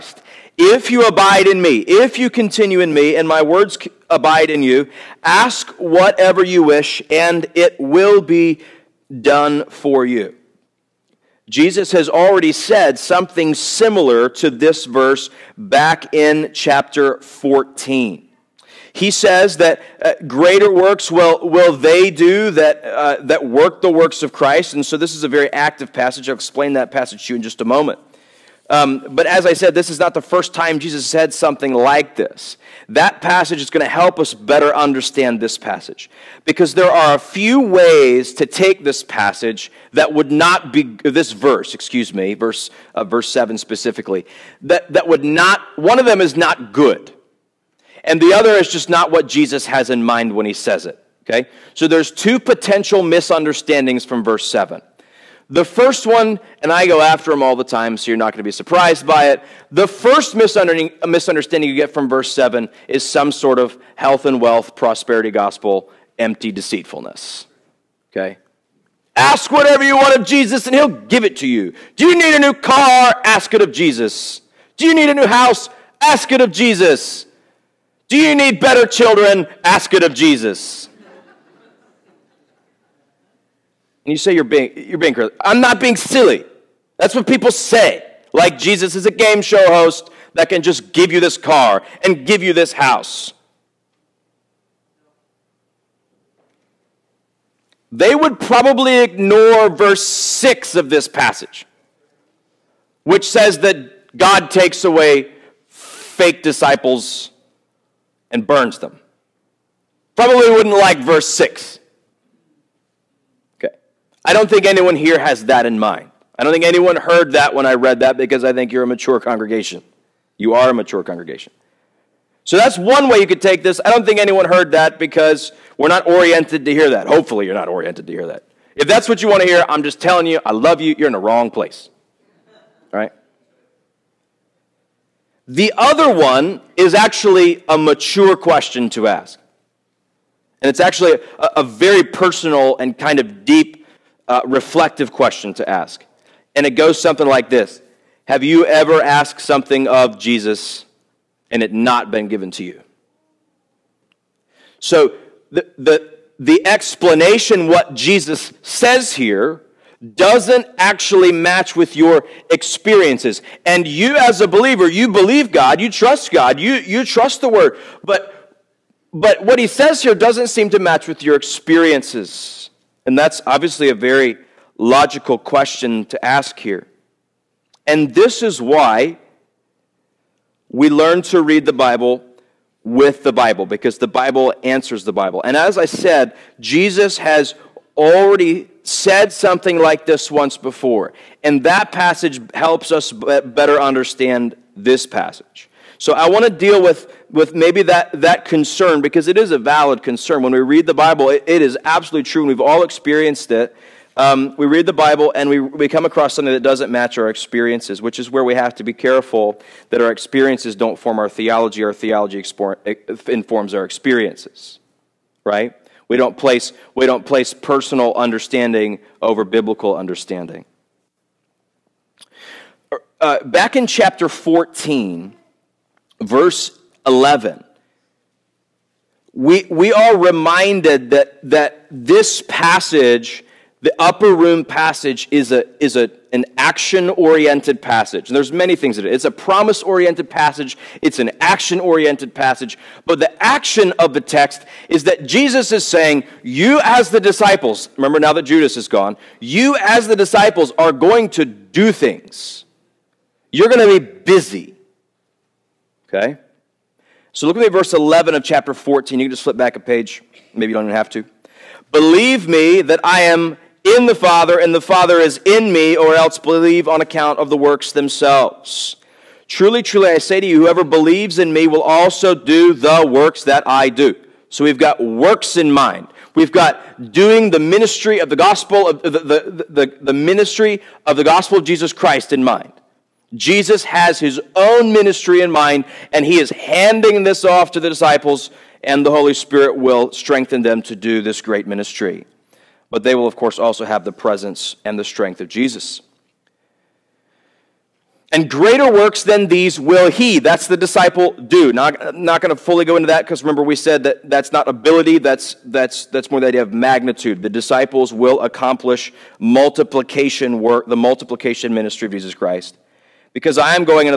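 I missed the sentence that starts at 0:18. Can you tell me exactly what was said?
He says that uh, greater works will, will they do that, uh, that work the works of Christ.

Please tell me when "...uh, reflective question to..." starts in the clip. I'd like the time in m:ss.
2:24.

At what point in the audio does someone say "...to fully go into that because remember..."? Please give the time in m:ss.
5:02.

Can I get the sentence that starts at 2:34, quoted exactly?
So the, the, the explanation what Jesus says here doesn't actually match with your experiences.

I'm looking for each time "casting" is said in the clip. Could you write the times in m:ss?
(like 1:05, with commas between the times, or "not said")
not said.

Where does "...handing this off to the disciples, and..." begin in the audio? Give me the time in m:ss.
4:46.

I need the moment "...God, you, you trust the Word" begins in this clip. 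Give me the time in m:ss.
2:46.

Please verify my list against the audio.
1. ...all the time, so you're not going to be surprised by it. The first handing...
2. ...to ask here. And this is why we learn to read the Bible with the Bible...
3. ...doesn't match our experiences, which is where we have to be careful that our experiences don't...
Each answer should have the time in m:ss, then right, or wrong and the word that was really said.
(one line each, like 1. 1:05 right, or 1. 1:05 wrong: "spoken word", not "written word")
1. 0:57 wrong: "misunderstanding", not "handing"
2. 2:56 right
3. 3:26 right.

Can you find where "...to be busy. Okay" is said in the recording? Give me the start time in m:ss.
4:13.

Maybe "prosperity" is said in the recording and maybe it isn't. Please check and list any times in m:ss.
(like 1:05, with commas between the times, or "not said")
1:04.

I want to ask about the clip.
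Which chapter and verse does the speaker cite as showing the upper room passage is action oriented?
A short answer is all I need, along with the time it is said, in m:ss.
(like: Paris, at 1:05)
Chapter 14, verse 11, at 3:43.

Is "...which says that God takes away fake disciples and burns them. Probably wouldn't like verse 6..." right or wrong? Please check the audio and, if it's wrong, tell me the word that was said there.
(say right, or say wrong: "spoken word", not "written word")
right.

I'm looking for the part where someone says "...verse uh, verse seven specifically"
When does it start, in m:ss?
0:42.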